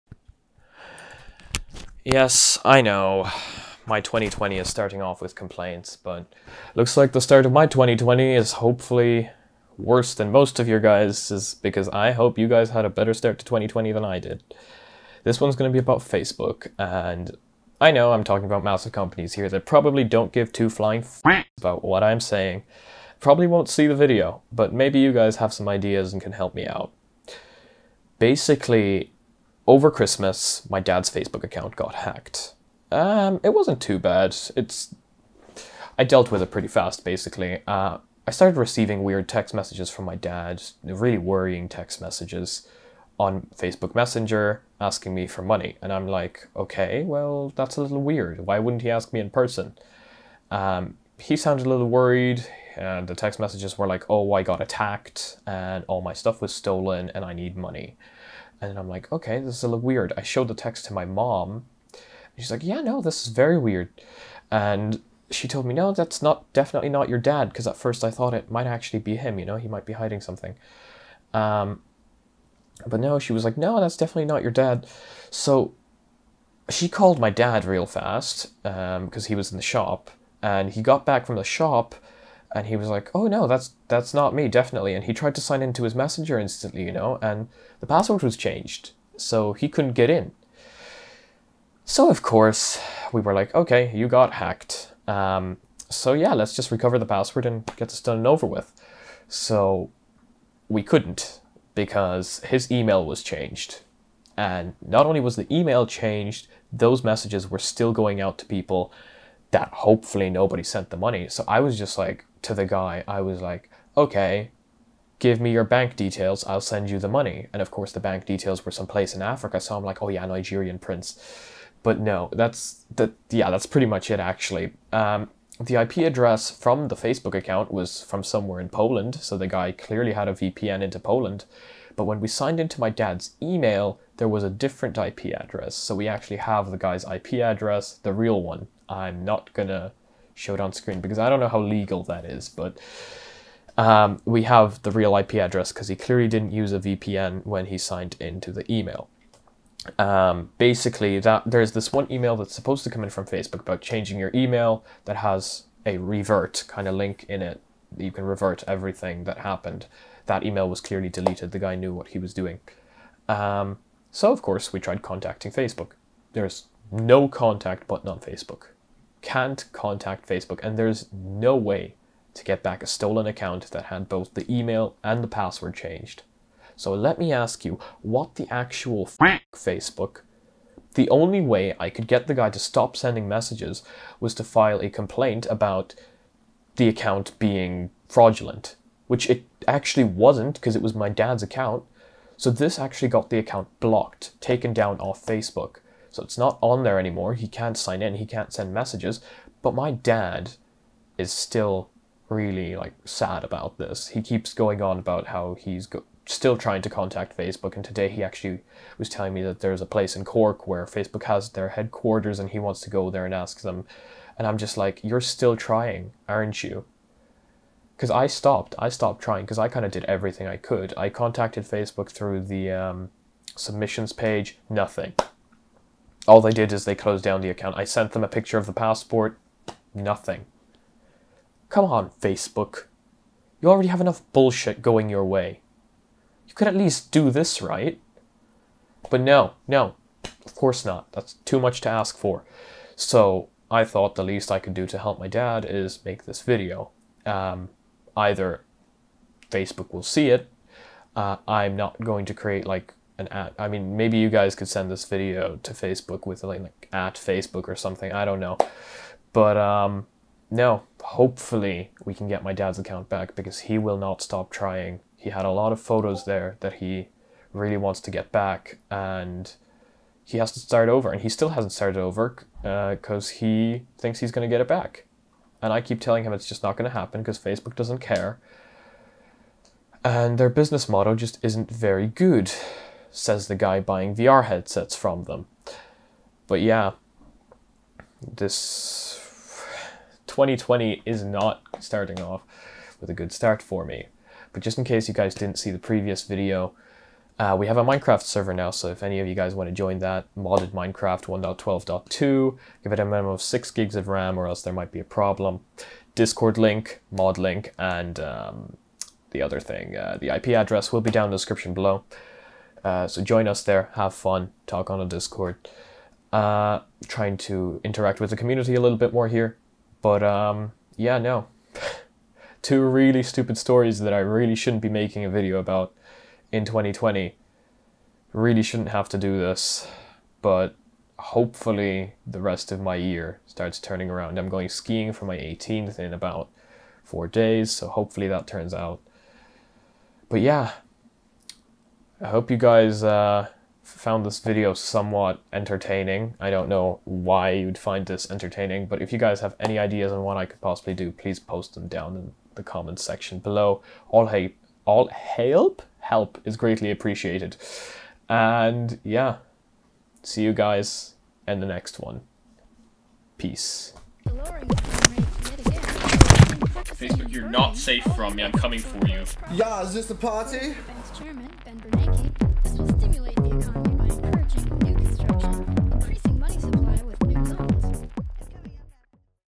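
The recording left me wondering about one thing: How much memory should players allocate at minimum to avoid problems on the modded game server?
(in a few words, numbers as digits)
6 gigs.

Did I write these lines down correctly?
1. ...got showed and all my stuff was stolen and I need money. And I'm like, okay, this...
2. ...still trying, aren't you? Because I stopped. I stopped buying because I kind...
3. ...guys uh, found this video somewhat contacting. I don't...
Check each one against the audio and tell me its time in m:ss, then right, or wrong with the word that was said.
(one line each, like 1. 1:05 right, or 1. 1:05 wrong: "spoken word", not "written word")
1. 0:54 wrong: "attacked", not "showed"
2. 3:35 wrong: "trying", not "buying"
3. 5:42 wrong: "entertaining", not "contacting".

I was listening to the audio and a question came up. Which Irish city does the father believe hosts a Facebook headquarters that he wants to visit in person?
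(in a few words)
Cork.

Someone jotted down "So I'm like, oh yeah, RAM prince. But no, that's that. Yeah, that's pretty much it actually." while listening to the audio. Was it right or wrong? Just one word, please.
wrong.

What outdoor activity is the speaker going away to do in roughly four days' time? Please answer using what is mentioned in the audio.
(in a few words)
Skiing.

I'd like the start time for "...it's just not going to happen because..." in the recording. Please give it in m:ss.
4:36.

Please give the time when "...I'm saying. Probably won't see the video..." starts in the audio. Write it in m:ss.
0:22.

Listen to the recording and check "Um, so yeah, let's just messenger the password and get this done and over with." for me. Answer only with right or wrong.
wrong.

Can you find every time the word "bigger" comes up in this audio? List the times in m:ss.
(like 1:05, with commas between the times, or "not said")
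not said.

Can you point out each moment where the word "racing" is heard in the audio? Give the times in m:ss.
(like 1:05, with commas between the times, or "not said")
not said.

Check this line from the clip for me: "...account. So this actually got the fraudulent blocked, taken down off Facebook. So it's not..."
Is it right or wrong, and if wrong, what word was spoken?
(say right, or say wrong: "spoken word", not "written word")
wrong: "account", not "fraudulent".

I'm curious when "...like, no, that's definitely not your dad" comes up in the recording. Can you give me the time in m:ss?
1:13.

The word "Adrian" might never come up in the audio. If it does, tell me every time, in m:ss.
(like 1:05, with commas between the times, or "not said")
not said.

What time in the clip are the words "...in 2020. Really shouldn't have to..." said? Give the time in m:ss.
5:26.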